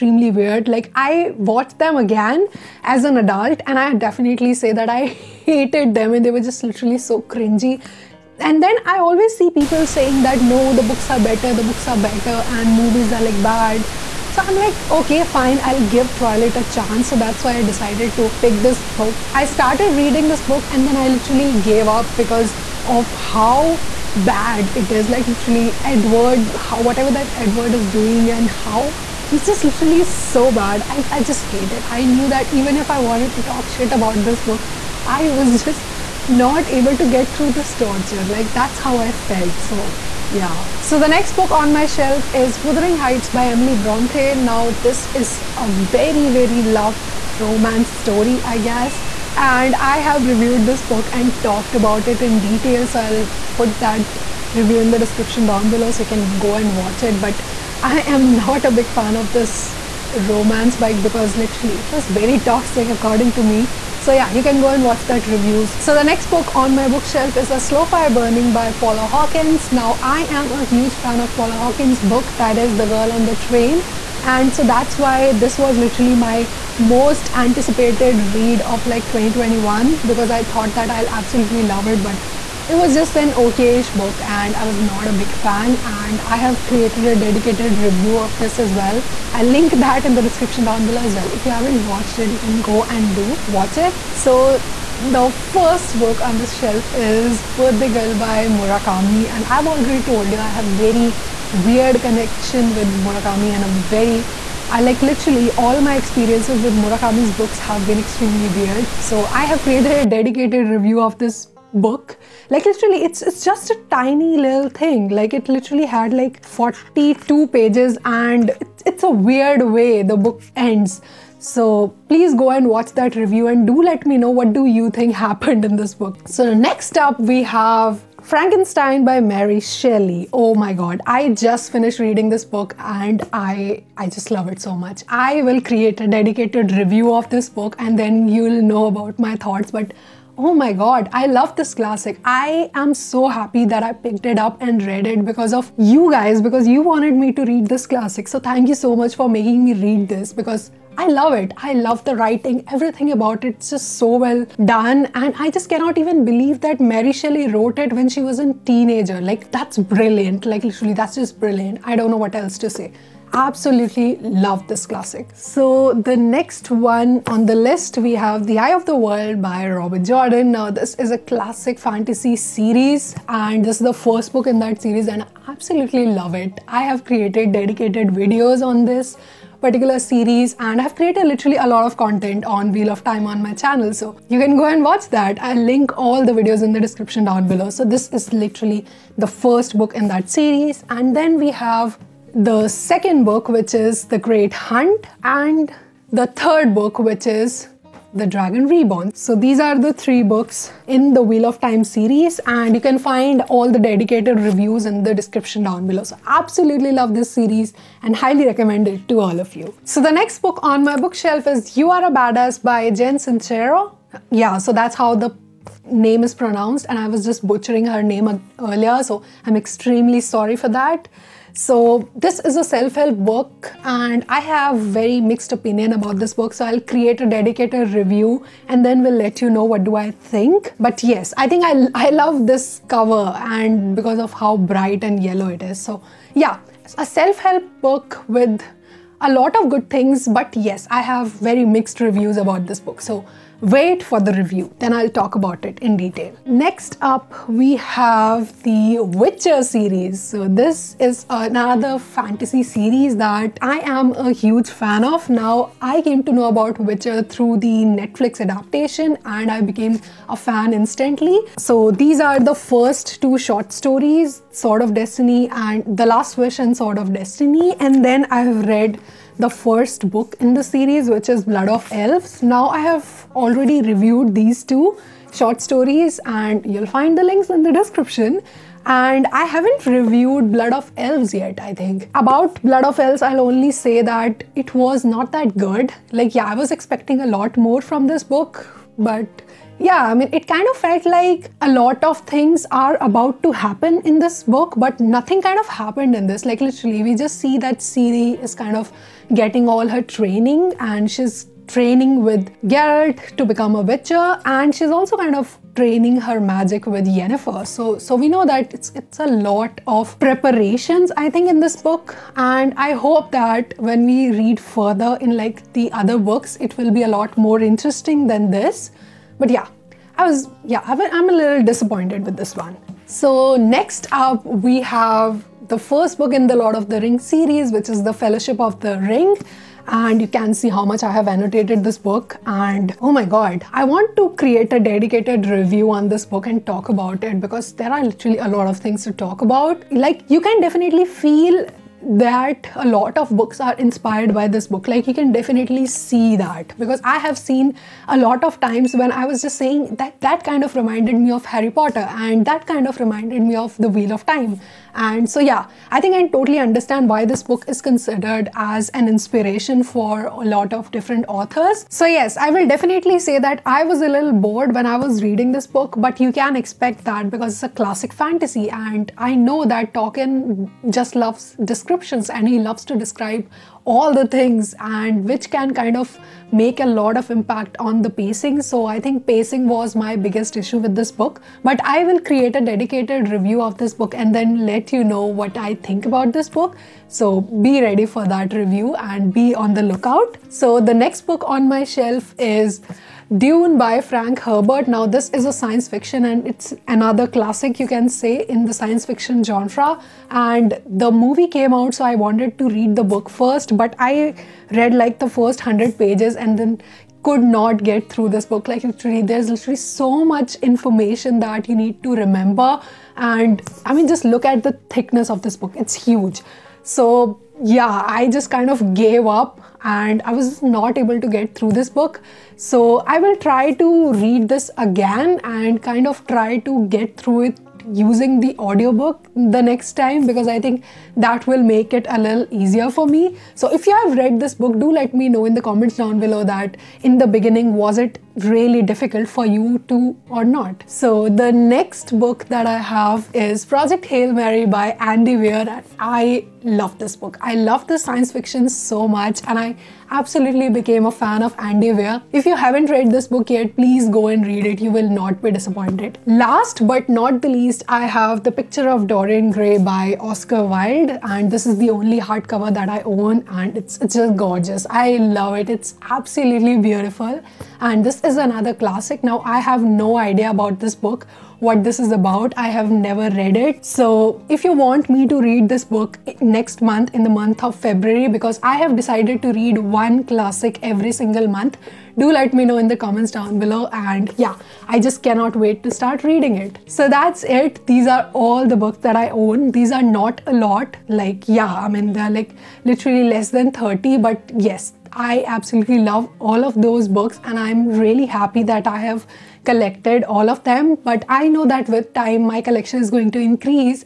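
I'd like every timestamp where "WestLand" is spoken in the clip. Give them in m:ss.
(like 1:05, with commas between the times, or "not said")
not said.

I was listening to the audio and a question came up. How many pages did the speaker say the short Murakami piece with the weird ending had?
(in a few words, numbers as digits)
42.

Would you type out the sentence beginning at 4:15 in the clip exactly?
Now, I came to know about Witcher through the Netflix adaptation and I became a fan instantly.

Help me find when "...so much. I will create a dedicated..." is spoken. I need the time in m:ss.
2:14.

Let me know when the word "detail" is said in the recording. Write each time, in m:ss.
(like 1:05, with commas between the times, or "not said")
0:52, 4:05.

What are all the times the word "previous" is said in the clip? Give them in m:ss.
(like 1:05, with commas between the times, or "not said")
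not said.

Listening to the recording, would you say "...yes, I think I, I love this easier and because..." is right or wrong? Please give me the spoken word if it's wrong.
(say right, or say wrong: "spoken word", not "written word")
wrong: "cover", not "easier".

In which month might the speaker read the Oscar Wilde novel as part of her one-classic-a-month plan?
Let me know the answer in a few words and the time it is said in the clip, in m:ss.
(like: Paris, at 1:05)
February, at 7:57.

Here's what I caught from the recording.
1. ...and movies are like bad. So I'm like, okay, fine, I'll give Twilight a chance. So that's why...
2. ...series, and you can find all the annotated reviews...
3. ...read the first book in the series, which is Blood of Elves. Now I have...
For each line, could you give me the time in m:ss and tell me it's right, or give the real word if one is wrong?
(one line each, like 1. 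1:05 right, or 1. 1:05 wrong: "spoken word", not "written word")
1. 0:12 right
2. 3:21 wrong: "dedicated", not "annotated"
3. 4:28 right.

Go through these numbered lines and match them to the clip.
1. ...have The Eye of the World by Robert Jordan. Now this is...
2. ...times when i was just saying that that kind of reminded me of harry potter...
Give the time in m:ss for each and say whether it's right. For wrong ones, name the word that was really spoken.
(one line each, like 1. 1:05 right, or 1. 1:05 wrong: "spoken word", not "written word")
1. 2:48 right
2. 5:48 right.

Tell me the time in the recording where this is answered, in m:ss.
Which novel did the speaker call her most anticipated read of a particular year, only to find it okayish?
1:07.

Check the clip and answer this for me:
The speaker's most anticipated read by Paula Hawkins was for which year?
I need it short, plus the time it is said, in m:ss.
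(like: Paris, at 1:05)
2021, at 1:19.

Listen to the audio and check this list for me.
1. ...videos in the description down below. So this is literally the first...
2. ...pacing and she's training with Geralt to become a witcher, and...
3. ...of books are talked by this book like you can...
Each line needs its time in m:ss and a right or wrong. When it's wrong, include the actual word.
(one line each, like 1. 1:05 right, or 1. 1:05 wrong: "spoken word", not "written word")
1. 3:06 right
2. 5:00 wrong: "training", not "pacing"
3. 5:43 wrong: "inspired", not "talked".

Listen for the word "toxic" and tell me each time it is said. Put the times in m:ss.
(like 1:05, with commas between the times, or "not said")
1:02.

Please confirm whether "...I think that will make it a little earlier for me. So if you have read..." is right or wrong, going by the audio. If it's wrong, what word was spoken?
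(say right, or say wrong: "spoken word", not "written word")
wrong: "easier", not "earlier".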